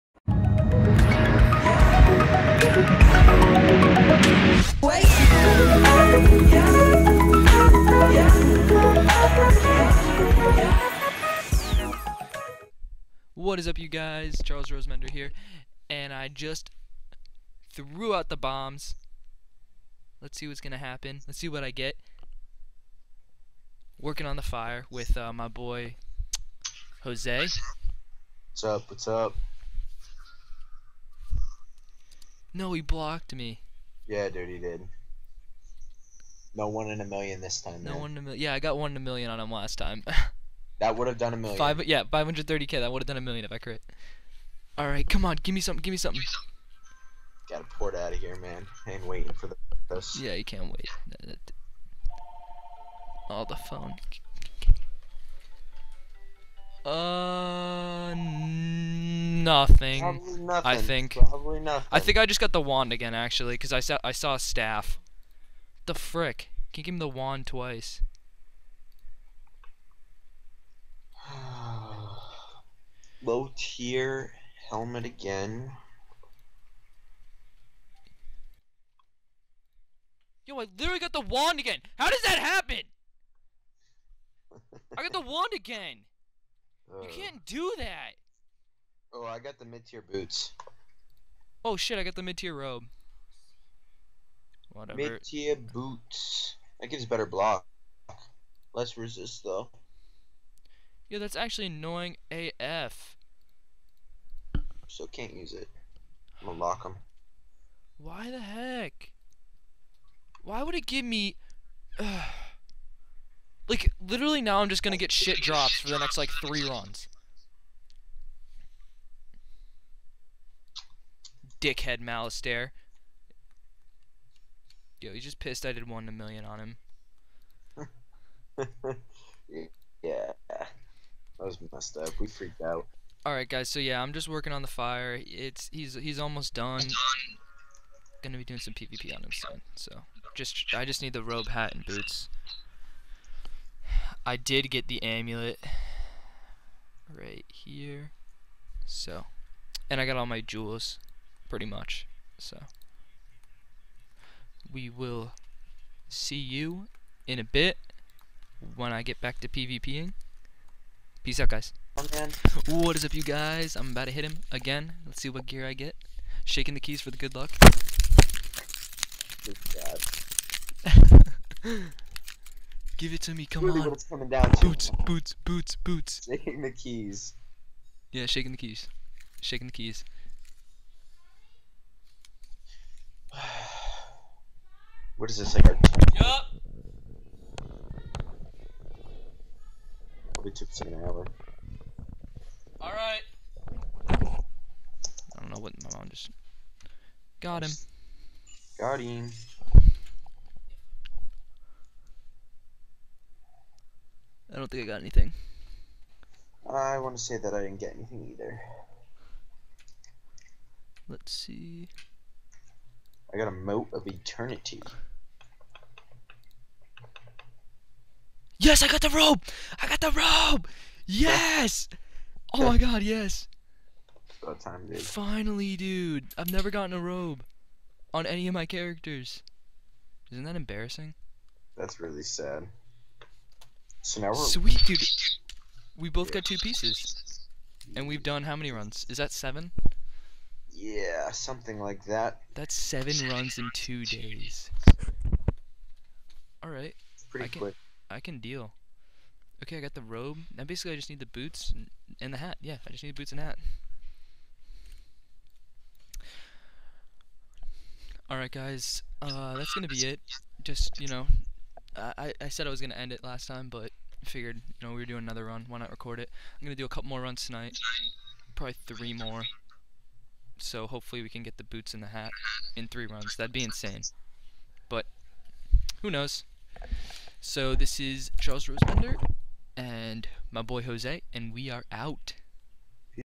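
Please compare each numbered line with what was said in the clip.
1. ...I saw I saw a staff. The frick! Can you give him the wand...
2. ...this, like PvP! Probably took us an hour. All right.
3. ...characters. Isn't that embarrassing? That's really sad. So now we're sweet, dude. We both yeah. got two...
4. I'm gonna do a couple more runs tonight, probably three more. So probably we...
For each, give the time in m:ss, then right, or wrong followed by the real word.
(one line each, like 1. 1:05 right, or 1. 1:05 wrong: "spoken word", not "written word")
1. 1:03 right
2. 3:05 wrong: "Yup", not "PvP"
3. 3:48 right
4. 4:26 wrong: "hopefully", not "probably".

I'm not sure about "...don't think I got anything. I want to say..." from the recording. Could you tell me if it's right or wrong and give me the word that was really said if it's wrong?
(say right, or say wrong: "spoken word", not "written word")
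right.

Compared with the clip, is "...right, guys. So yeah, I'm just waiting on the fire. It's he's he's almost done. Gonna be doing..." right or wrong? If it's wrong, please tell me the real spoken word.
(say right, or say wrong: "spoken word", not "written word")
wrong: "working", not "waiting".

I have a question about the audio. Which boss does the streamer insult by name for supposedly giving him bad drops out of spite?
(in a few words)
Malistaire.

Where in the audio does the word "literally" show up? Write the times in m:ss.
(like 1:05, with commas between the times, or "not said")
1:20, 1:54.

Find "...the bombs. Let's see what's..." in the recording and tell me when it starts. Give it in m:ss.
0:18.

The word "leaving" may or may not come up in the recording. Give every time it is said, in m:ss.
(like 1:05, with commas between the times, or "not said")
not said.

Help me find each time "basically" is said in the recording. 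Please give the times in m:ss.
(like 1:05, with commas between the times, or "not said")
4:10.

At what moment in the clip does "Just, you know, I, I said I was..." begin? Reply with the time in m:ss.
4:20.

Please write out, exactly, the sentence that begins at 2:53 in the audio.
What's coming down boots, boots, boots, boots.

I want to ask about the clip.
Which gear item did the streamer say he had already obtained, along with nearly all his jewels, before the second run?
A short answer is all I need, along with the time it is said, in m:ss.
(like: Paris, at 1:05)
amulet, at 2:25.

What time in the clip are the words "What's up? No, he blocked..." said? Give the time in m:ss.
0:28.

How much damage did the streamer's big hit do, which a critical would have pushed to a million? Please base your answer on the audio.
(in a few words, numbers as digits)
530k.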